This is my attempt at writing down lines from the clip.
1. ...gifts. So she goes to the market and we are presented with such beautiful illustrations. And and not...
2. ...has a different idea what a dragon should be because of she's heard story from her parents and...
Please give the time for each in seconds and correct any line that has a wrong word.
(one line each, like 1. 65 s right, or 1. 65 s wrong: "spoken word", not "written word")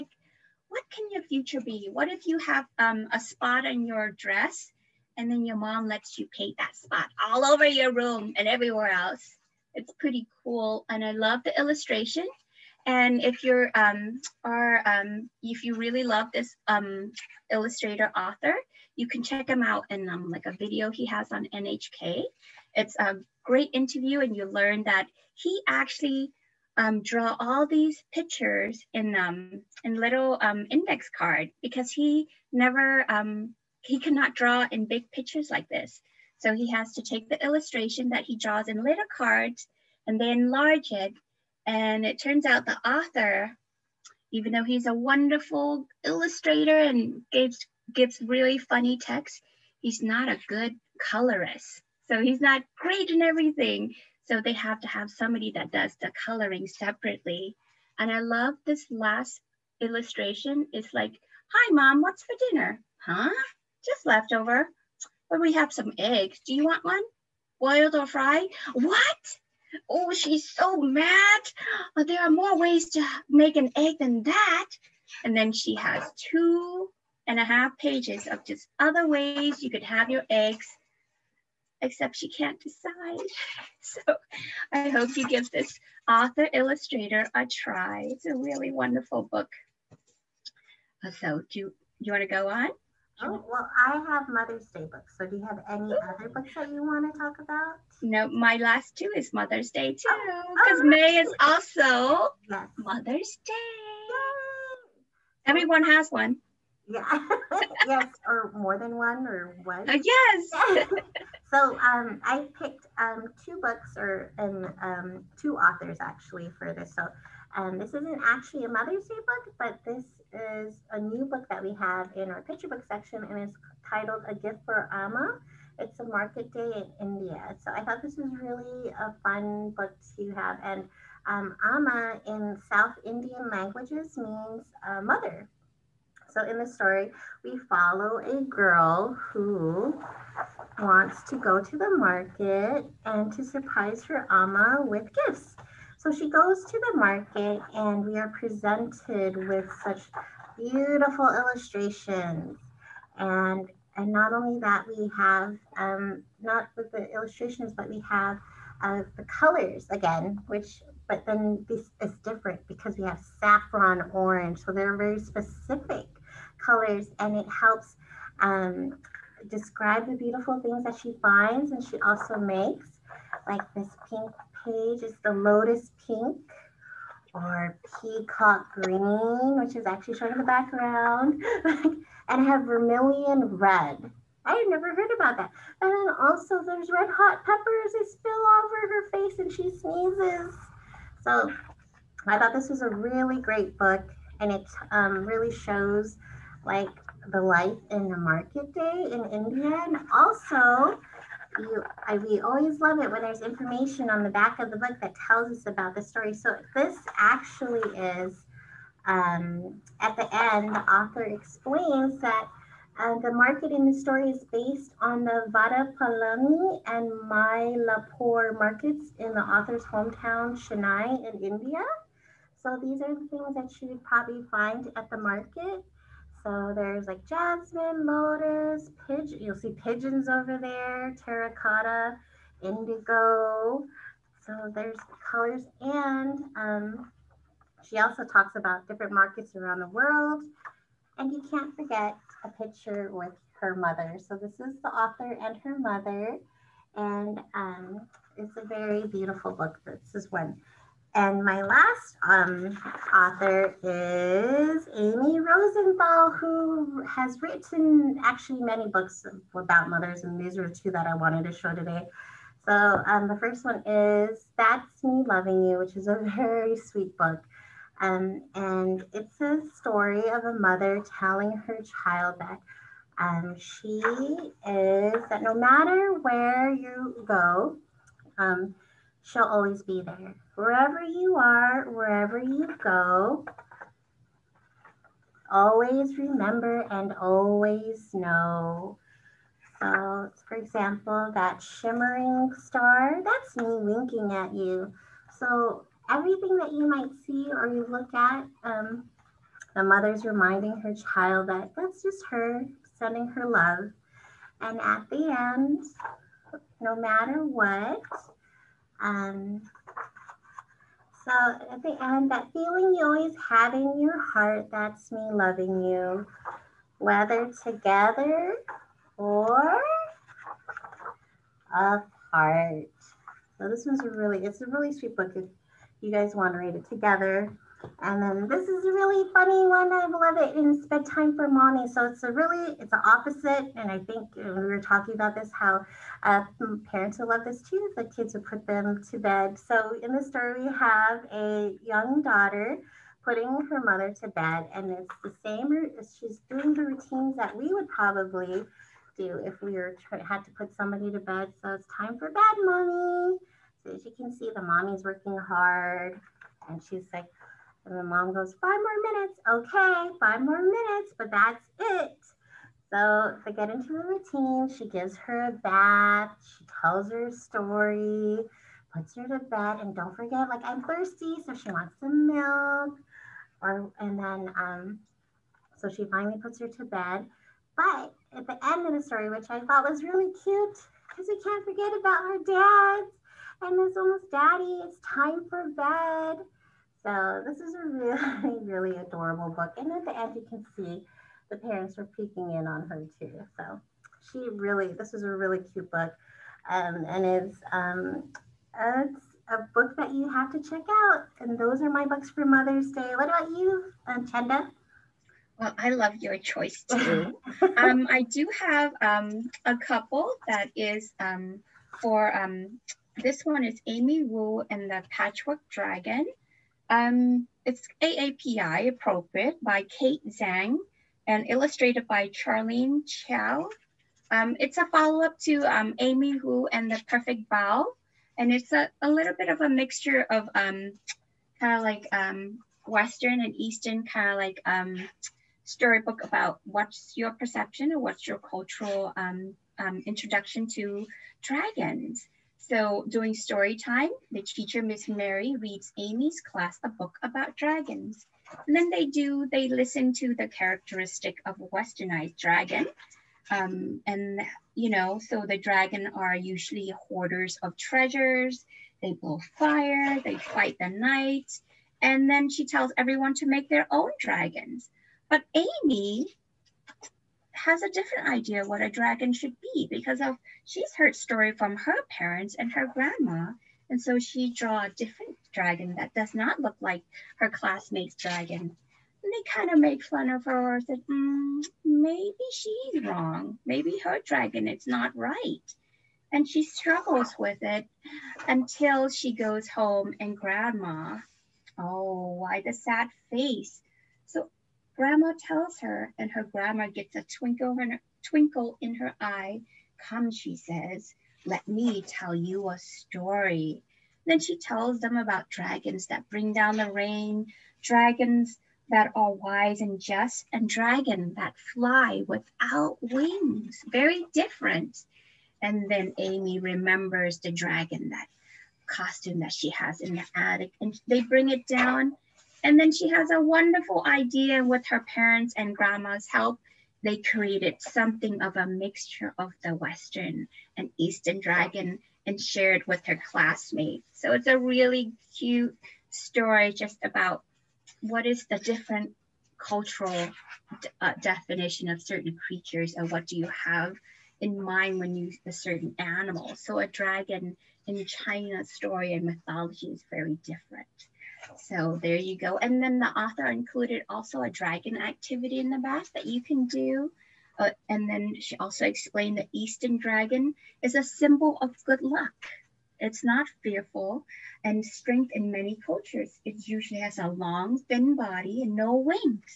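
1. 145 s right
2. 467 s right.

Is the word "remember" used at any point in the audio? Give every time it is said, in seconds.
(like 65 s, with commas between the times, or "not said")
286 s, 516 s.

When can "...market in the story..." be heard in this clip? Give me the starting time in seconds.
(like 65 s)
213 s.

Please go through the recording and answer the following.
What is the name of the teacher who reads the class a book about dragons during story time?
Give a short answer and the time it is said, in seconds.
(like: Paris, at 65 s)
Miss Mary, at 444 s.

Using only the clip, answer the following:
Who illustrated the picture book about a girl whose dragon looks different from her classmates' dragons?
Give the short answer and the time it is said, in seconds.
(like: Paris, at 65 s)
Charlene Chua, at 422 s.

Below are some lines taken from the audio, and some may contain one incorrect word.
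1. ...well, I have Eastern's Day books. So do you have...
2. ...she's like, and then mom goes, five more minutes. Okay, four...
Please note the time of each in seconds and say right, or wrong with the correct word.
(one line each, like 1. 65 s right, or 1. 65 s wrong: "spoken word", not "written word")
1. 93 s wrong: "Mother", not "Eastern"
2. 356 s wrong: "five", not "four".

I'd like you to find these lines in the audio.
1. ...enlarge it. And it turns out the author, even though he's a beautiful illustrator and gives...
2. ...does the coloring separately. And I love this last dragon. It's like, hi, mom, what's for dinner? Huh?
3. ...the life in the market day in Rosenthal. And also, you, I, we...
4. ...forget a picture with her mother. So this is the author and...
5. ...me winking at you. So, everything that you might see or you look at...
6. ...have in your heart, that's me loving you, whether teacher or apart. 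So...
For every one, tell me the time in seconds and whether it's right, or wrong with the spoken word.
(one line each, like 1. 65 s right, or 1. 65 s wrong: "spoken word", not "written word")
1. 40 s wrong: "wonderful", not "beautiful"
2. 55 s wrong: "illustration", not "dragon"
3. 197 s wrong: "India", not "Rosenthal"
4. 241 s right
5. 293 s right
6. 313 s wrong: "together", not "teacher".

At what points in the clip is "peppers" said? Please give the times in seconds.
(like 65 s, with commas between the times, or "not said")
187 s.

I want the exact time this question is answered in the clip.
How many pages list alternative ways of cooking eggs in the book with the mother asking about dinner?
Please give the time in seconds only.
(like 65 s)
76 s.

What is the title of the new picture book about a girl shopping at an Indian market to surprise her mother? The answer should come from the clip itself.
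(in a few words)
A Gift for Amma.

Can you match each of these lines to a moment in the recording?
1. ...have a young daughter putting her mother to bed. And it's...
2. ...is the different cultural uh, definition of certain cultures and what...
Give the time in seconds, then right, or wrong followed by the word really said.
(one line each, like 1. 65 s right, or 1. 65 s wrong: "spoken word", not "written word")
1. 340 s right
2. 538 s wrong: "creatures", not "cultures".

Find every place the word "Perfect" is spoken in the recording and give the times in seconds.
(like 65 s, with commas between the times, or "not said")
427 s.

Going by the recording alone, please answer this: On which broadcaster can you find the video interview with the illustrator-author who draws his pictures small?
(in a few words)
NHK.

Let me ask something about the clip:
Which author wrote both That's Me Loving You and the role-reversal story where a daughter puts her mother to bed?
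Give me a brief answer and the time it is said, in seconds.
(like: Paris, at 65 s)
Amy Rosenthal, at 254 s.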